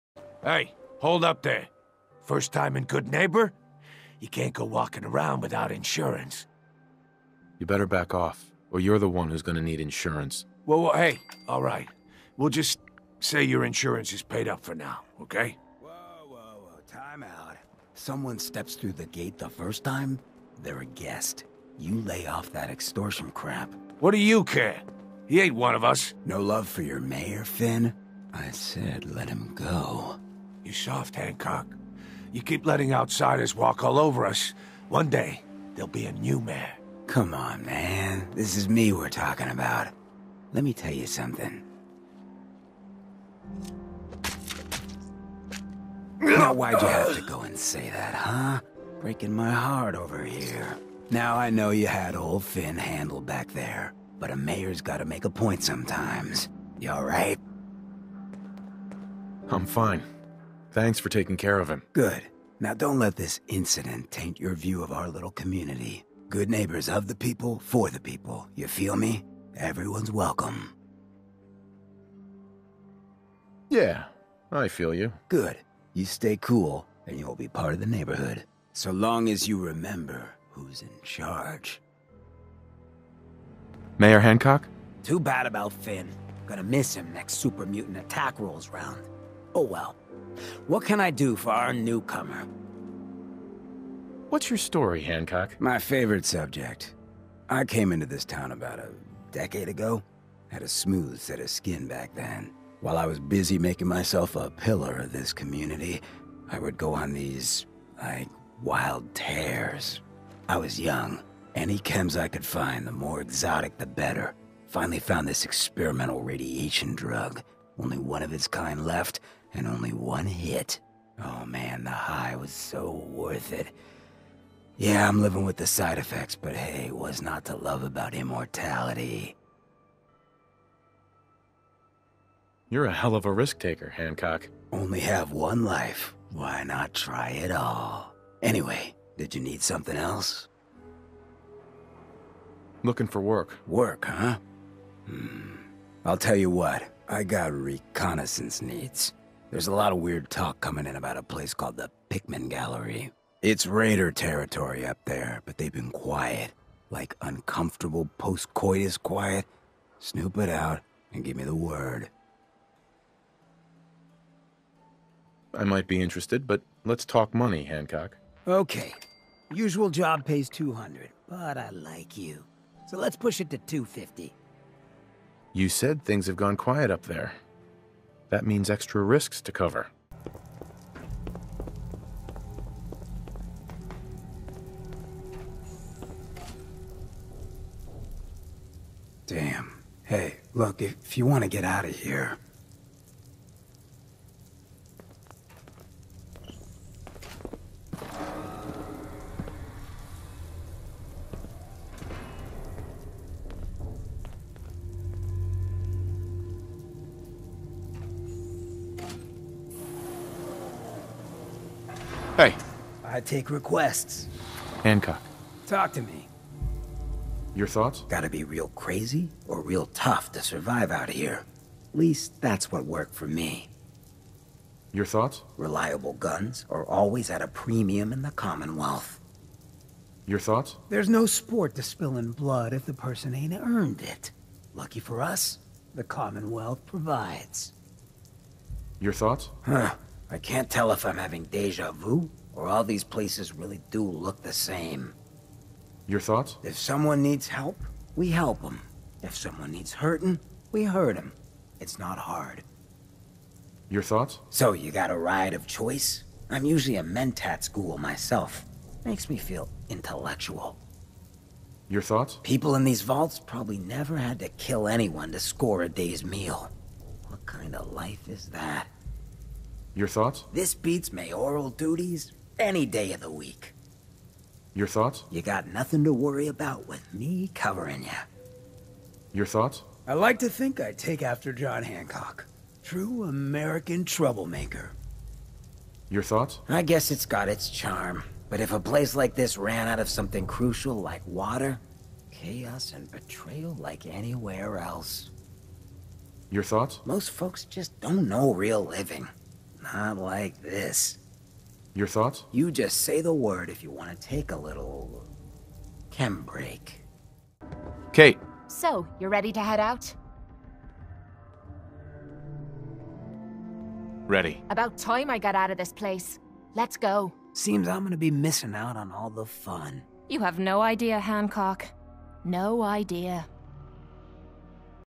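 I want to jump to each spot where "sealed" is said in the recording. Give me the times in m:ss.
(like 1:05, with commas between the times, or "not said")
not said.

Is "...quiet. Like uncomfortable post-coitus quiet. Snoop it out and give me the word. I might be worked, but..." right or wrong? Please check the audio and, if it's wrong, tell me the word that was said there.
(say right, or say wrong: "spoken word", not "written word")
wrong: "interested", not "worked".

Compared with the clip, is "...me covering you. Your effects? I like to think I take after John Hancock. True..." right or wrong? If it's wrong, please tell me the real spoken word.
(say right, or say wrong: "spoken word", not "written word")
wrong: "thoughts", not "effects".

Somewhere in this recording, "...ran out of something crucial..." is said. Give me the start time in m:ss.
4:49.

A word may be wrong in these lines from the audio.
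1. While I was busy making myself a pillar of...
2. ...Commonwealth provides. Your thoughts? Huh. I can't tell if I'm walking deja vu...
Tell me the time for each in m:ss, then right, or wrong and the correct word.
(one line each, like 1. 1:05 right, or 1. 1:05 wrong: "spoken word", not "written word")
1. 1:42 right
2. 3:56 wrong: "having", not "walking".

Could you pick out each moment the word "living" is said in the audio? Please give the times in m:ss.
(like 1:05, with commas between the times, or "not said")
2:05, 4:58.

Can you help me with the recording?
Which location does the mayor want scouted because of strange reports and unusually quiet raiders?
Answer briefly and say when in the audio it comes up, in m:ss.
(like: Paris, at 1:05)
Pickman Gallery, at 2:32.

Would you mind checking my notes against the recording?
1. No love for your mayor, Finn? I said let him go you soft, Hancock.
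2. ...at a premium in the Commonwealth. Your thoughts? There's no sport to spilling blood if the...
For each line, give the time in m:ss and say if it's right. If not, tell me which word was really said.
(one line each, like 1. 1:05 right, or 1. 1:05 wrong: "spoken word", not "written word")
1. 0:26 right
2. 3:47 right.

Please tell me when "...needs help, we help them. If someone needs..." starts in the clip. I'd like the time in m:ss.
4:07.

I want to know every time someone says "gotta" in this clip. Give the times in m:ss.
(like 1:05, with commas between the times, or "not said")
0:54, 3:38.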